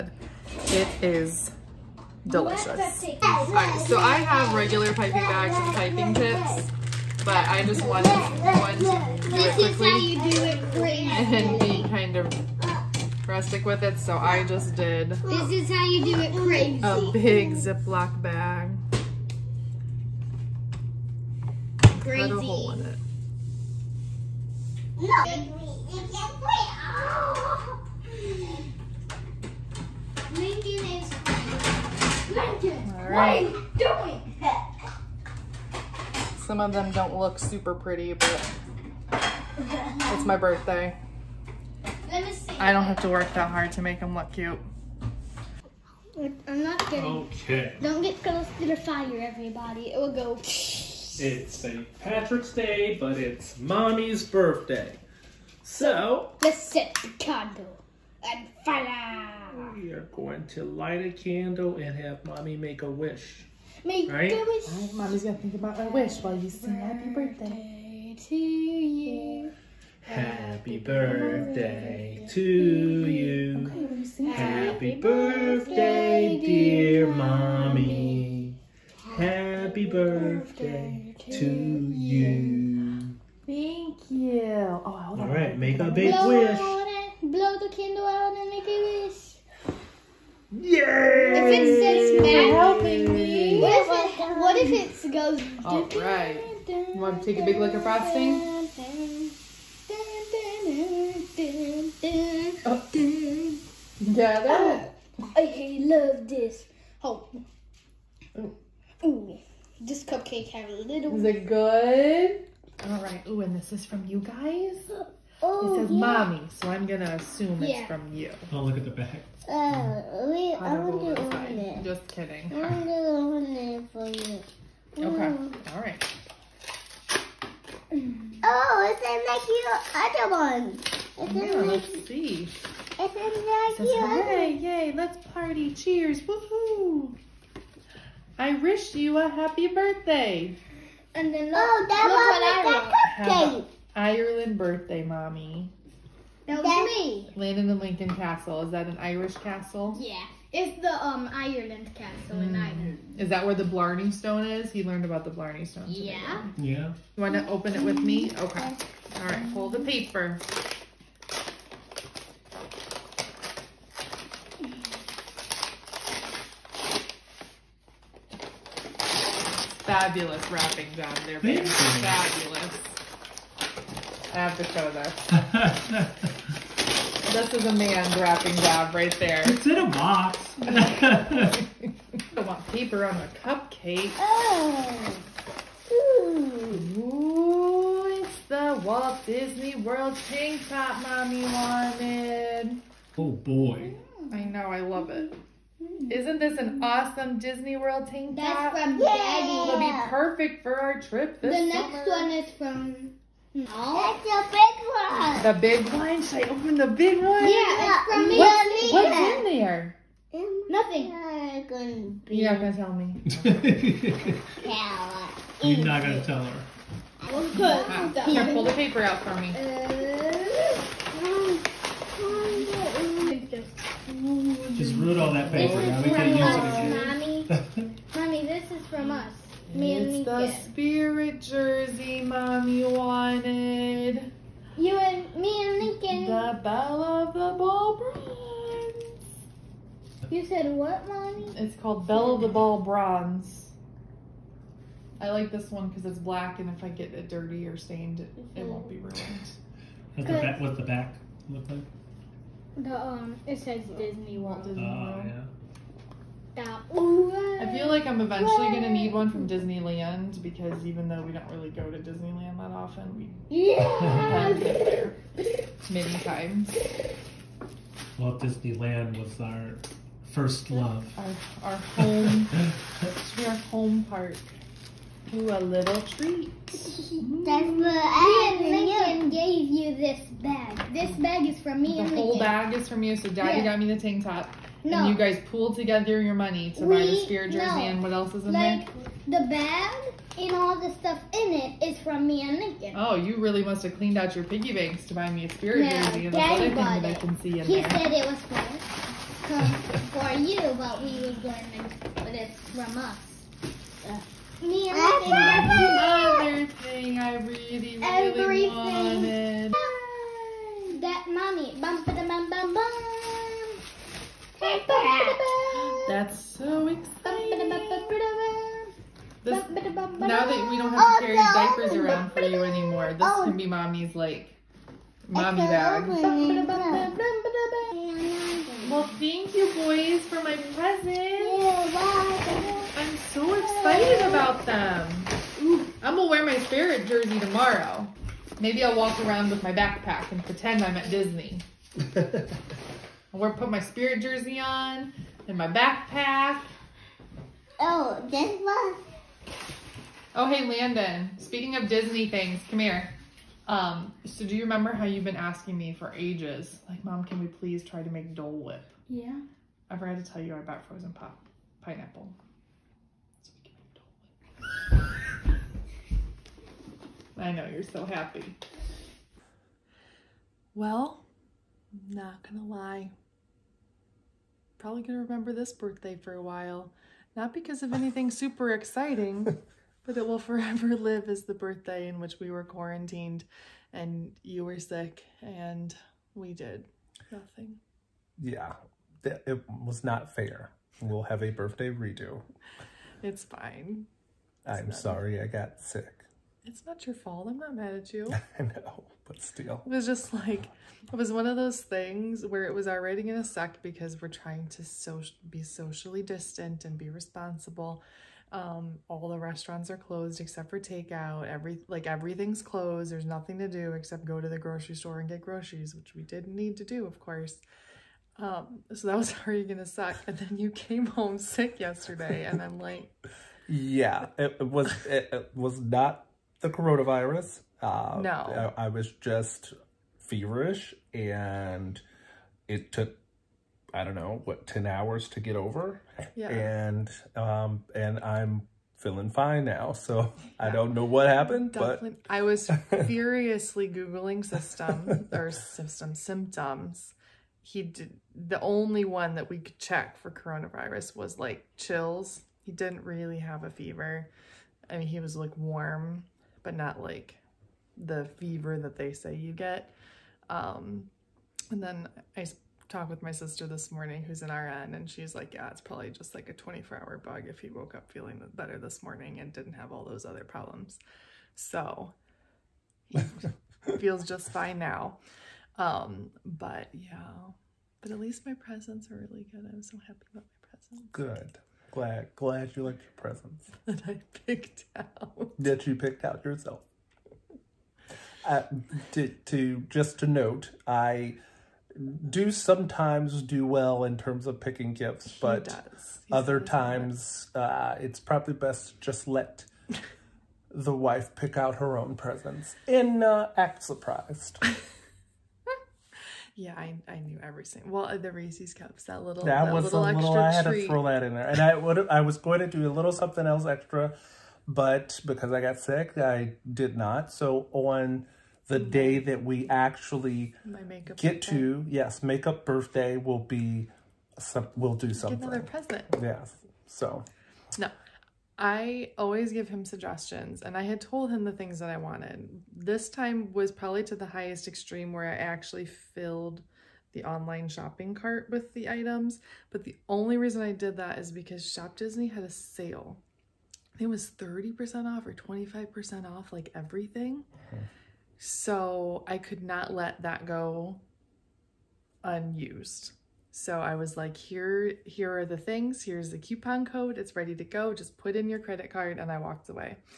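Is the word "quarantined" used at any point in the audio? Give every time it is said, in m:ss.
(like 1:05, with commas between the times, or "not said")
6:22.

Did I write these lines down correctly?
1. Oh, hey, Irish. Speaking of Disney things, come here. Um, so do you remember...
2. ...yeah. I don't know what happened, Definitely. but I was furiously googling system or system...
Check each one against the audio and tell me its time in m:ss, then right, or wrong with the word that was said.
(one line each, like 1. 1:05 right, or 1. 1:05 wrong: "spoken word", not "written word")
1. 5:50 wrong: "Landon", not "Irish"
2. 7:20 right.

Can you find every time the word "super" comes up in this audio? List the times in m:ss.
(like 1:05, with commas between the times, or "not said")
0:37, 6:18.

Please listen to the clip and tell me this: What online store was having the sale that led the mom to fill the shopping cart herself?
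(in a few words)
Shop Disney.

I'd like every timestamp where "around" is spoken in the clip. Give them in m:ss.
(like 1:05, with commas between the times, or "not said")
5:21, 5:39.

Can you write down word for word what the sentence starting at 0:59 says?
We are going to light a candle and have Mommy make a wish.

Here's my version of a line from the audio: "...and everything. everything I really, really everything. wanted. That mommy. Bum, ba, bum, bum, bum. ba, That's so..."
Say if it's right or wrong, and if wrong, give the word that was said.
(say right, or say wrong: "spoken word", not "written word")
right.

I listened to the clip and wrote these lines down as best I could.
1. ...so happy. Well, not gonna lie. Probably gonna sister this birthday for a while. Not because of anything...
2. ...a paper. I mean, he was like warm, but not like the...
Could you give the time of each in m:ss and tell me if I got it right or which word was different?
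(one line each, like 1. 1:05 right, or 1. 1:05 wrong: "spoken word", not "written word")
1. 6:07 wrong: "remember", not "sister"
2. 7:33 wrong: "fever", not "paper".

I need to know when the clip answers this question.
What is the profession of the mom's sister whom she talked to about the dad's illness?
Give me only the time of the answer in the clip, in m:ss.
7:44.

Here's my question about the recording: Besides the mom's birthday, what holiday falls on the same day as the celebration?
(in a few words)
St. Patrick's Day.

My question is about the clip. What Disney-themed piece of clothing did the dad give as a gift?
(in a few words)
Walt Disney World tank top.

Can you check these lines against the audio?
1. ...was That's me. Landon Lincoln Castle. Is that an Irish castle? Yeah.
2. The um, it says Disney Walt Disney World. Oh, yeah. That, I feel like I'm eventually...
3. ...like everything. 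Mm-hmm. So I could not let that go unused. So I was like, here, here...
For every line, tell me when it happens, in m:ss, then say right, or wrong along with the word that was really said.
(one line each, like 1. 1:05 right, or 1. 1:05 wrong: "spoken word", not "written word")
1. 2:26 right
2. 4:12 right
3. 9:06 right.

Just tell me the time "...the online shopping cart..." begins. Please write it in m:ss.
8:57.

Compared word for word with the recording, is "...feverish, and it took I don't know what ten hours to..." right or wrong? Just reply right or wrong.
right.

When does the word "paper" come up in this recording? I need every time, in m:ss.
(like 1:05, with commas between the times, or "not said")
2:39, 3:02, 3:38, 3:45.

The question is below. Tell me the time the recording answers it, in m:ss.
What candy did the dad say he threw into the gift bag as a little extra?
8:28.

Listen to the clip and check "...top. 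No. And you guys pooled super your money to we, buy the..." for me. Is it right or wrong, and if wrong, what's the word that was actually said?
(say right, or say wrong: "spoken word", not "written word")
wrong: "together", not "super".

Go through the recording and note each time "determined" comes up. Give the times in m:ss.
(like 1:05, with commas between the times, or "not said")
not said.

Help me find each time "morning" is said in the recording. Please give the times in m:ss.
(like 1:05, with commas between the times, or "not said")
7:43, 7:49.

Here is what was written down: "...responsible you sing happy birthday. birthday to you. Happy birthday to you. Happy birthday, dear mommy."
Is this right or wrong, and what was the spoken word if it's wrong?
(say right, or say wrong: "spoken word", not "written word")
wrong: "while", not "responsible".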